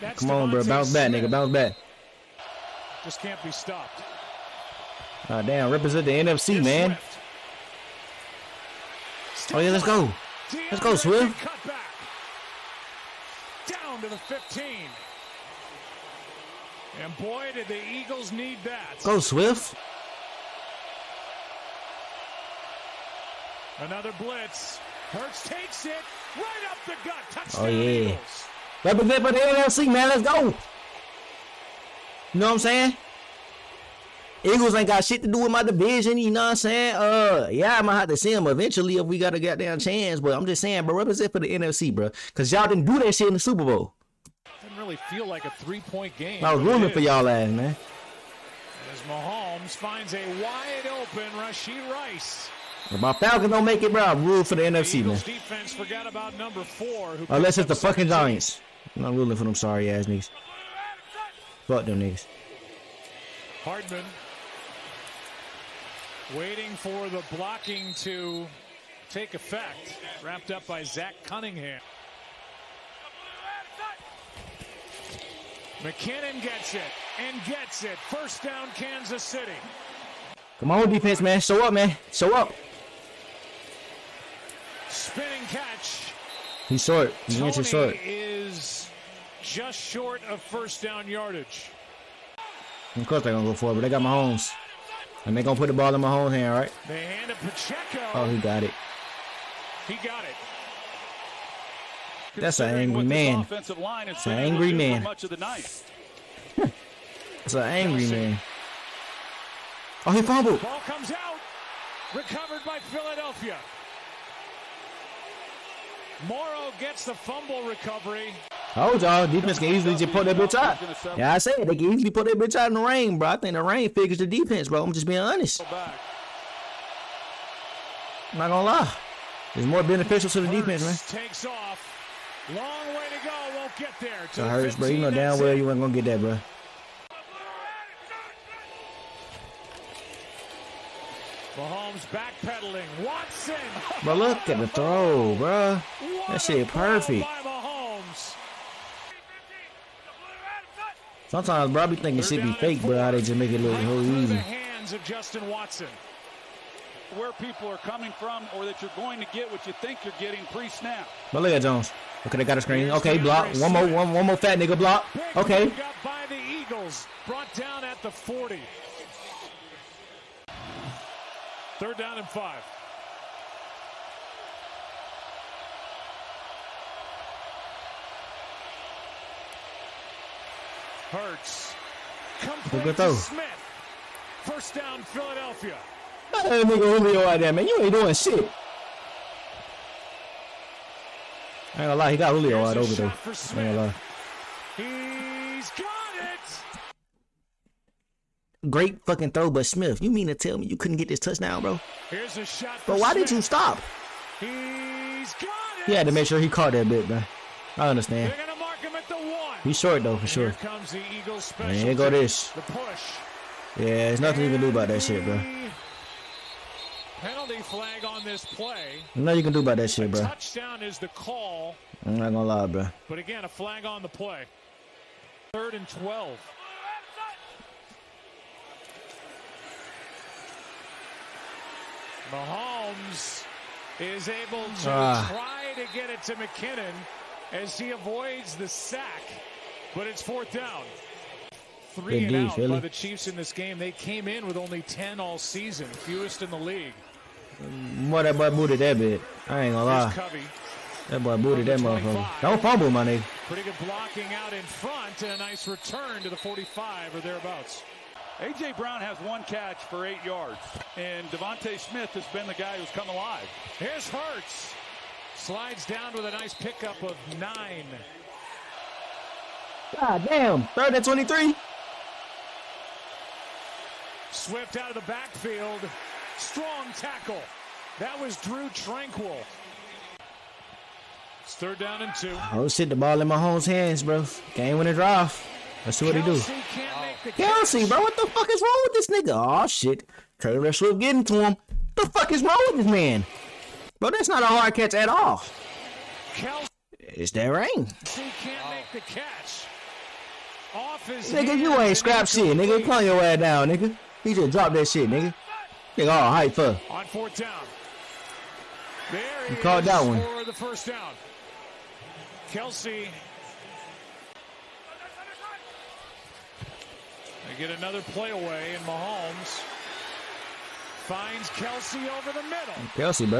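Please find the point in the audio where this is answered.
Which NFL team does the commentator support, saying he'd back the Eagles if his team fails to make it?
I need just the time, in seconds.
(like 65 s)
53 s.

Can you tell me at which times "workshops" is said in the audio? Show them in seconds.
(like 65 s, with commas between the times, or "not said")
not said.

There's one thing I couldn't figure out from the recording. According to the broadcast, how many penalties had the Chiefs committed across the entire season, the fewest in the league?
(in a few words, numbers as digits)
10.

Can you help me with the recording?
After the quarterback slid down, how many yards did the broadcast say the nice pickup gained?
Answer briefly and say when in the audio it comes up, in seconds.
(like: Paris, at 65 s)
9, at 267 s.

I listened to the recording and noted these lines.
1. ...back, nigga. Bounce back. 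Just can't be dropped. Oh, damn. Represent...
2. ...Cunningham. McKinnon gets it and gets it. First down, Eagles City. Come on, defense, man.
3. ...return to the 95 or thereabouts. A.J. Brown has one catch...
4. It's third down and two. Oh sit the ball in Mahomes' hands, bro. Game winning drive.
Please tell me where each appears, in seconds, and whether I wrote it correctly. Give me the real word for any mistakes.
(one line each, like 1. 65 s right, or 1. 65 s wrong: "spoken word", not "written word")
1. 1 s wrong: "stopped", not "dropped"
2. 71 s wrong: "Kansas", not "Eagles"
3. 255 s wrong: "45", not "95"
4. 281 s right.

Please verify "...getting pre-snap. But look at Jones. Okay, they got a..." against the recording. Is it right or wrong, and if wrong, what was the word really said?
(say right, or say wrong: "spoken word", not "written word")
right.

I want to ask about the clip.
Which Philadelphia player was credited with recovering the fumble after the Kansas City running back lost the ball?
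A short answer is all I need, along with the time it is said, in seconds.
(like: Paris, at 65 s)
Morrow, at 116 s.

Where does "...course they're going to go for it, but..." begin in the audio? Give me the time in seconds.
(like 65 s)
93 s.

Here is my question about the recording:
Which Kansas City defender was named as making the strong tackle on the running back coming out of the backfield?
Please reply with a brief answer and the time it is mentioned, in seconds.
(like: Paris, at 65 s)
Drue Tranquill, at 278 s.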